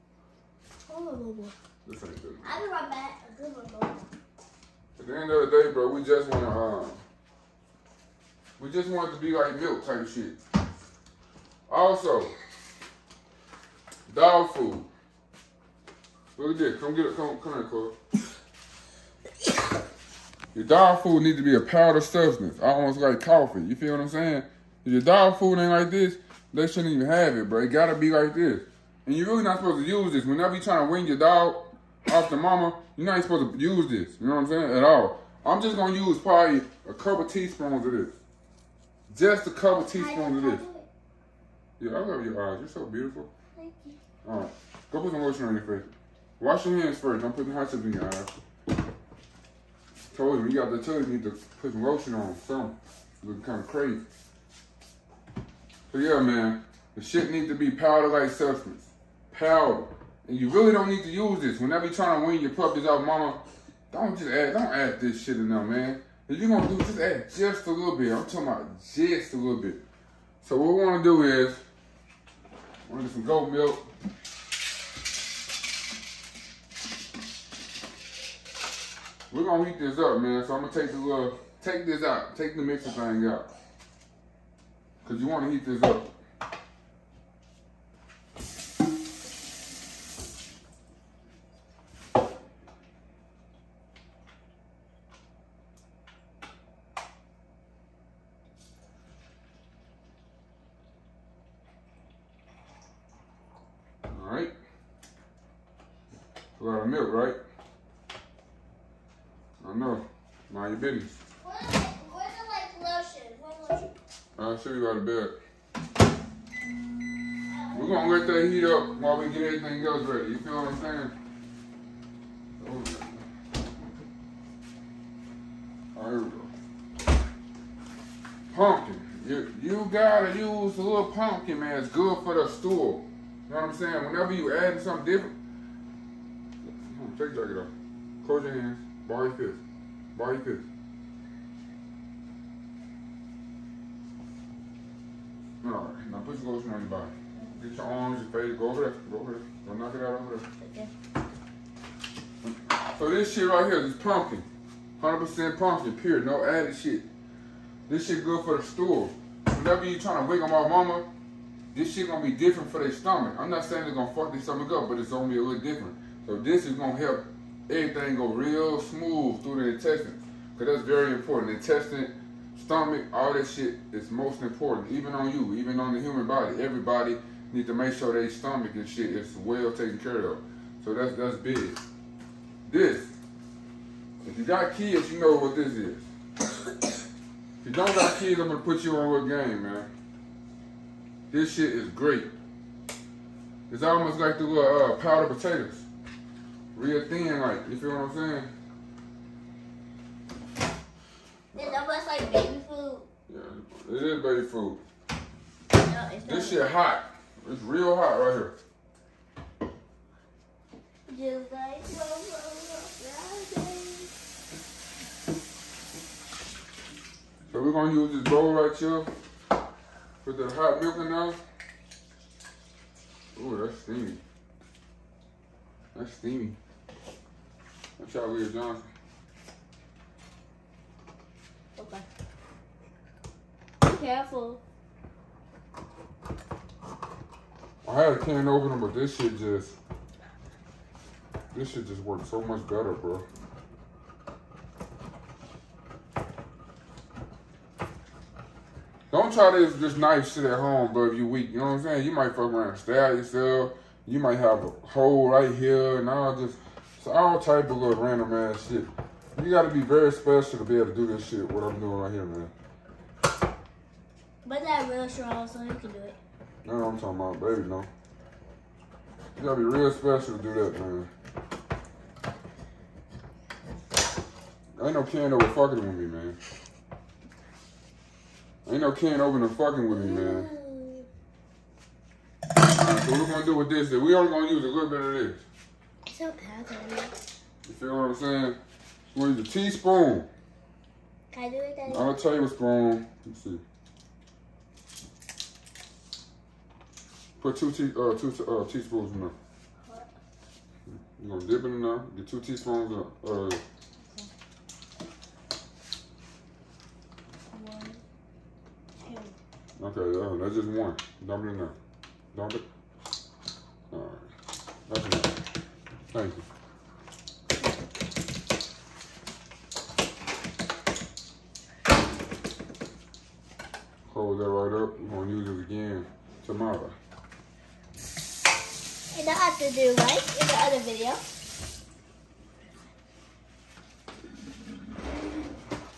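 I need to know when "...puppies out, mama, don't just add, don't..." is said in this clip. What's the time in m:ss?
1:02.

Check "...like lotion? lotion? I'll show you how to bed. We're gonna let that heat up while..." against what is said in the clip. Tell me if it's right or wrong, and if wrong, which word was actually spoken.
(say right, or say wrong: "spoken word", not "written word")
right.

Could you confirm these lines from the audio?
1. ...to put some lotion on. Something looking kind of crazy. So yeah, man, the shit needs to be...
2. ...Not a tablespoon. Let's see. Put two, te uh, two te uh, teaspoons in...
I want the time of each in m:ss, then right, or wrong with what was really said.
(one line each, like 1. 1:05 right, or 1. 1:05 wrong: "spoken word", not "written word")
1. 0:51 right
2. 4:51 right.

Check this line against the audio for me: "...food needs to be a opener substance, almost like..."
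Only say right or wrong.
wrong.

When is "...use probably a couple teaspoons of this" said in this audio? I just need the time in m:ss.
0:35.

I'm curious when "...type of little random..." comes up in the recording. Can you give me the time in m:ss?
4:17.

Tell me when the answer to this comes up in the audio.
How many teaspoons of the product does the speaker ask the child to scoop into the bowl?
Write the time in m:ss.
5:02.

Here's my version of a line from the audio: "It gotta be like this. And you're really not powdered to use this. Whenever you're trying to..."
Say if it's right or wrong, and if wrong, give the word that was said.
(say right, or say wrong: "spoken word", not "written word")
wrong: "supposed", not "powdered".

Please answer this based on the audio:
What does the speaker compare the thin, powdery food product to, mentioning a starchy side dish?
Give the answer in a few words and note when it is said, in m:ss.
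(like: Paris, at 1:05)
Powdered potatoes, at 3:14.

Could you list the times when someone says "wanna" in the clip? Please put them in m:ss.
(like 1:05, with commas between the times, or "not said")
1:10, 1:25.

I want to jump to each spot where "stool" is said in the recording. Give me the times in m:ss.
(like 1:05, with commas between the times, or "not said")
2:12, 2:38.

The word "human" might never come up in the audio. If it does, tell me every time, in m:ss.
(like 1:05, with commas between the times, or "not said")
2:56.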